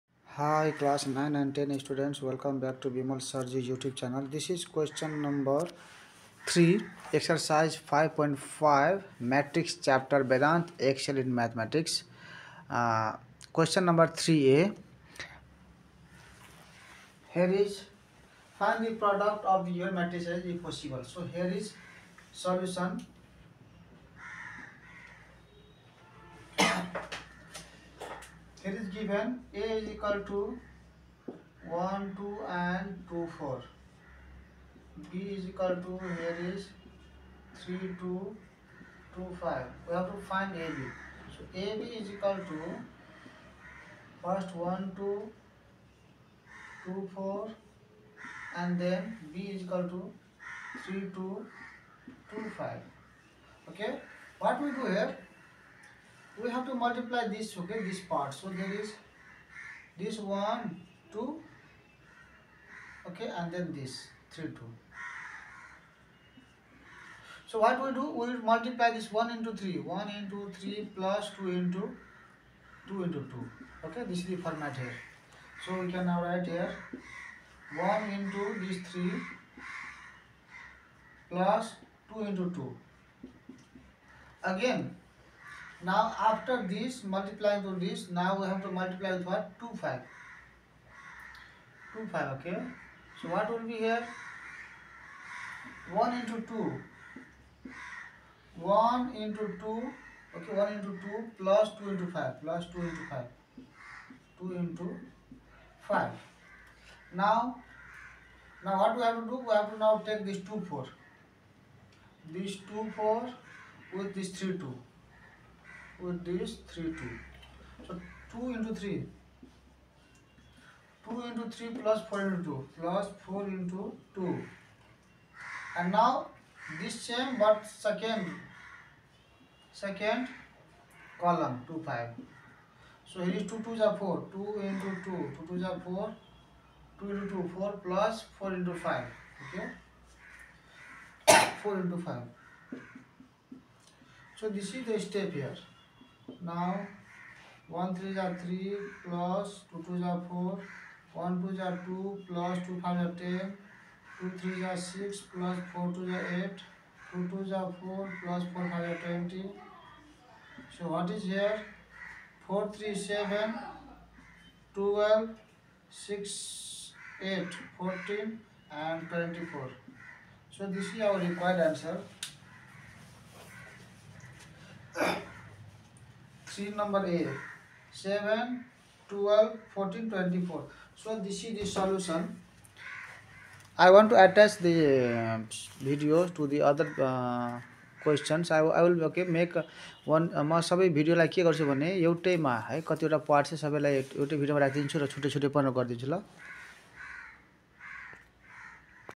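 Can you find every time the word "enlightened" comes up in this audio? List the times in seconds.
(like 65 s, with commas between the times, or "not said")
not said.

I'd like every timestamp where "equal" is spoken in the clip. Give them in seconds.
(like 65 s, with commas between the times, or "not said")
29 s, 35 s, 42 s, 49 s.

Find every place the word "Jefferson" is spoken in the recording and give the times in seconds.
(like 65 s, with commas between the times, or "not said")
not said.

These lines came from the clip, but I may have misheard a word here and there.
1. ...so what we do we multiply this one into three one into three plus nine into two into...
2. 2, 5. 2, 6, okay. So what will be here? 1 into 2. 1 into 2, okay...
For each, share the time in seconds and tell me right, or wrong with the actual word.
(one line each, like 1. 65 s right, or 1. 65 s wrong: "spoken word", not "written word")
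1. 67 s wrong: "two", not "nine"
2. 89 s wrong: "5", not "6".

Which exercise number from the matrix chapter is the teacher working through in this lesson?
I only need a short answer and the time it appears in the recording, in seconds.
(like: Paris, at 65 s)
5.5, at 7 s.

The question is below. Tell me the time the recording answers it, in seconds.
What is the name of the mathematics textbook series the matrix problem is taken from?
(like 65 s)
10 s.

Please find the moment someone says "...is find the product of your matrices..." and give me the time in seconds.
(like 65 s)
17 s.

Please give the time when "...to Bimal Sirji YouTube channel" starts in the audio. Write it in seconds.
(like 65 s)
2 s.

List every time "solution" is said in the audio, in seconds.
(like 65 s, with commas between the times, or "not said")
22 s, 181 s.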